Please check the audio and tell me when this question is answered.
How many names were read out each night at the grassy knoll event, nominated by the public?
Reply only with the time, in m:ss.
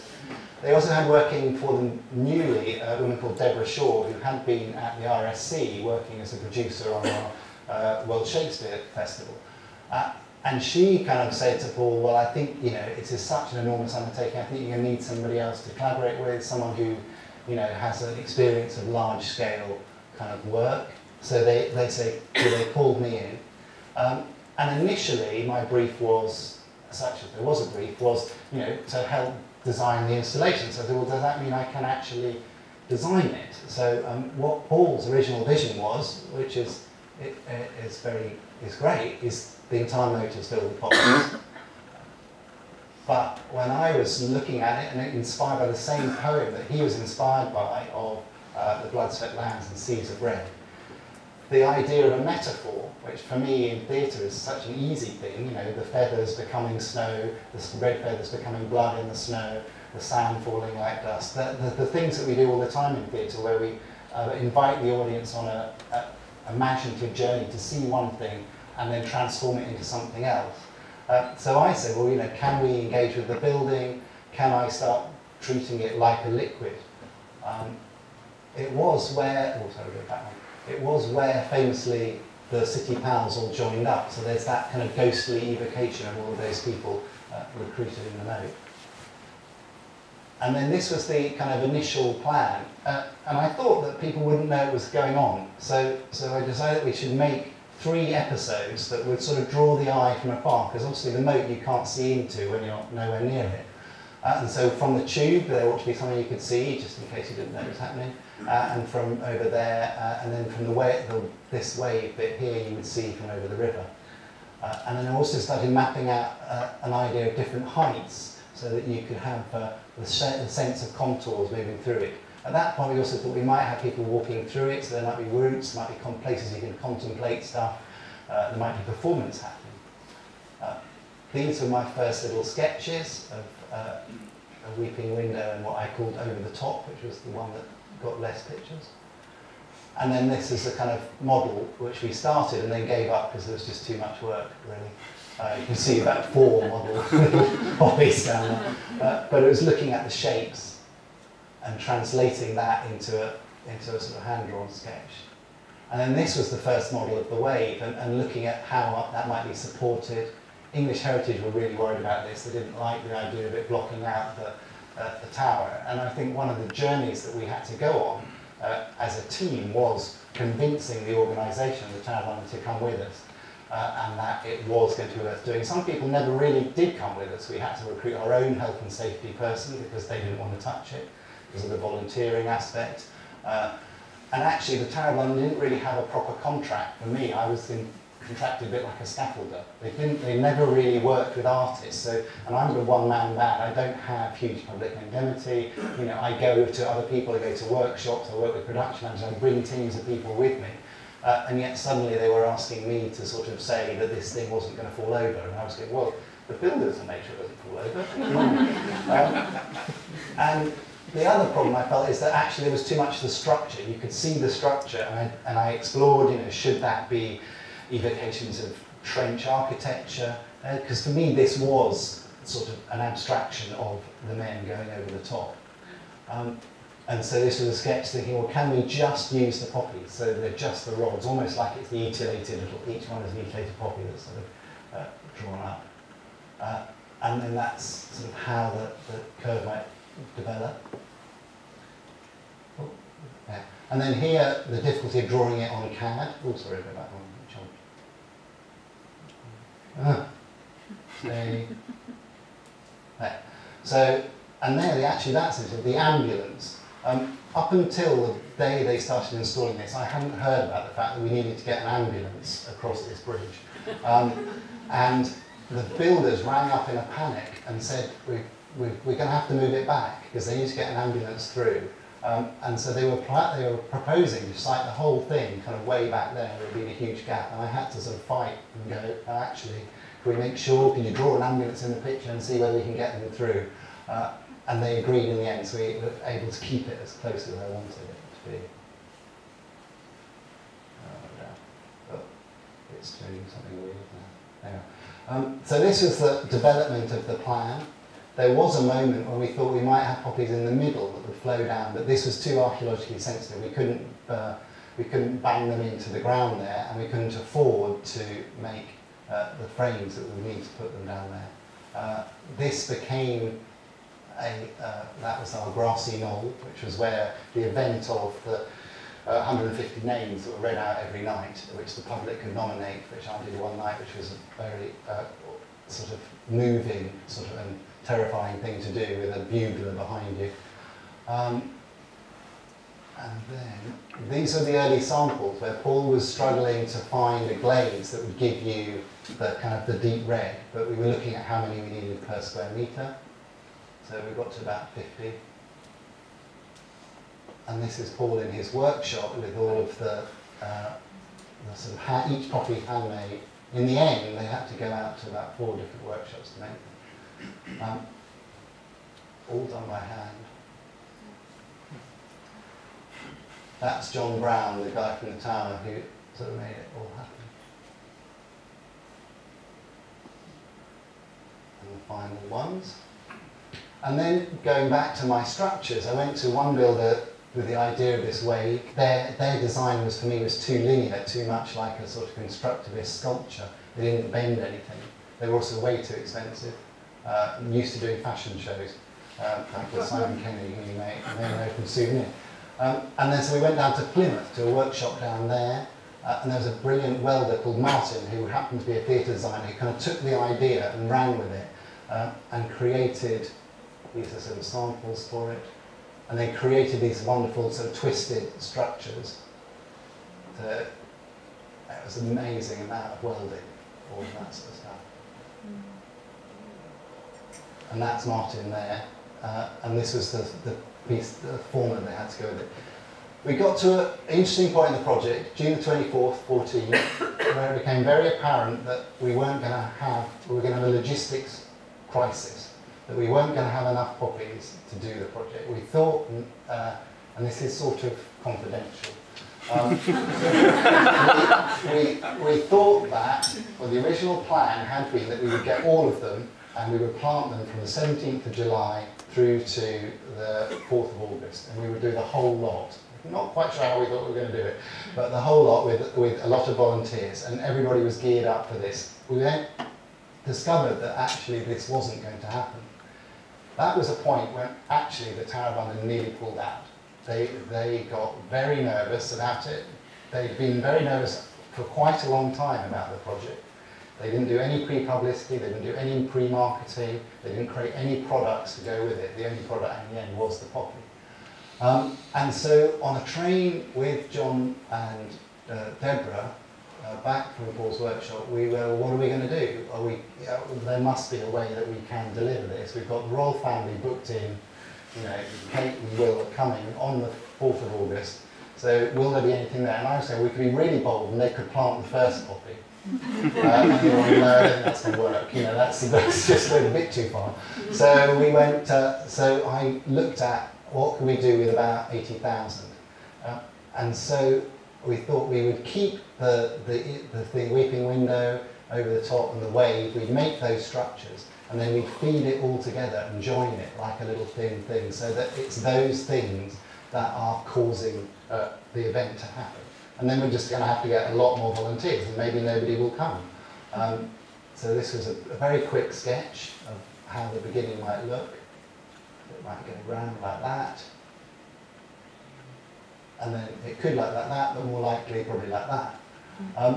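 5:19.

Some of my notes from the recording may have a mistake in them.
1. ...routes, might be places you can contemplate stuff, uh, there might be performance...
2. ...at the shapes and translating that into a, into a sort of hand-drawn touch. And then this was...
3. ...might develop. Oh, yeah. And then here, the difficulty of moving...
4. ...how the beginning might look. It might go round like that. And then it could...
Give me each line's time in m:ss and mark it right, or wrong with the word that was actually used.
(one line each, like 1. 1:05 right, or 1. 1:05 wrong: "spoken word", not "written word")
1. 2:05 right
2. 2:29 wrong: "sketch", not "touch"
3. 3:59 wrong: "drawing", not "moving"
4. 8:57 right.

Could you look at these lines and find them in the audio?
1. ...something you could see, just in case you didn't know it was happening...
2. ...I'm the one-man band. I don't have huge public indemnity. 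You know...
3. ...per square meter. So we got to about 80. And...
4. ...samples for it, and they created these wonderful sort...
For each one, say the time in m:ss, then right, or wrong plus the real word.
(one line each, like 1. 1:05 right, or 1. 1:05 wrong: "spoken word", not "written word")
1. 1:45 right
2. 3:12 right
3. 5:42 wrong: "50", not "80"
4. 6:44 right.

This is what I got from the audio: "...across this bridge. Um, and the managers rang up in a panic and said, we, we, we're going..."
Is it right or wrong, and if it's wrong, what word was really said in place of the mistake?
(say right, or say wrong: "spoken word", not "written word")
wrong: "builders", not "managers".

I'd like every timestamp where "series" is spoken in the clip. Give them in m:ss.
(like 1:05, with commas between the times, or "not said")
not said.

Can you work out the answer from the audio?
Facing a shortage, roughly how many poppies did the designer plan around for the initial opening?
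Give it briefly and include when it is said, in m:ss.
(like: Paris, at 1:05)
About 80,000, at 8:31.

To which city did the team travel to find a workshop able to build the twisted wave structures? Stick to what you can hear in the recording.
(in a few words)
Plymouth.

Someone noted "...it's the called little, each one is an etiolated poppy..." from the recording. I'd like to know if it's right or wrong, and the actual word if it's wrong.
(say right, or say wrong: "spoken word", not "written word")
wrong: "etiolated", not "called".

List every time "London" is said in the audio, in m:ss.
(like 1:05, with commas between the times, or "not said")
2:52, 3:05, 7:45.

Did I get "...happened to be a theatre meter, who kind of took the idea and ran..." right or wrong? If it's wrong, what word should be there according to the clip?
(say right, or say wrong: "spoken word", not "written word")
wrong: "designer", not "meter".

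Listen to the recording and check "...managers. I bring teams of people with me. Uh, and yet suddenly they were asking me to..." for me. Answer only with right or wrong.
right.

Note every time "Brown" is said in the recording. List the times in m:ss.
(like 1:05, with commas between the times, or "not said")
6:04.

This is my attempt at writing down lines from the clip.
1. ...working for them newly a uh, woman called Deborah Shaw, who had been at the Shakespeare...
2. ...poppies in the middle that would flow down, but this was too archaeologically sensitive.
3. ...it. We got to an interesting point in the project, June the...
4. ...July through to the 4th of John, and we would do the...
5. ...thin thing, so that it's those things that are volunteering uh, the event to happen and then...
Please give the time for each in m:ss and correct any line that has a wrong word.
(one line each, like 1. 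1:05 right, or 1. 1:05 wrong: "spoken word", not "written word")
1. 0:01 wrong: "RSC", not "Shakespeare"
2. 5:00 right
3. 7:02 right
4. 7:28 wrong: "August", not "John"
5. 8:44 wrong: "causing", not "volunteering".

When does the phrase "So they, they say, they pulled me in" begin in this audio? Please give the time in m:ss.
0:21.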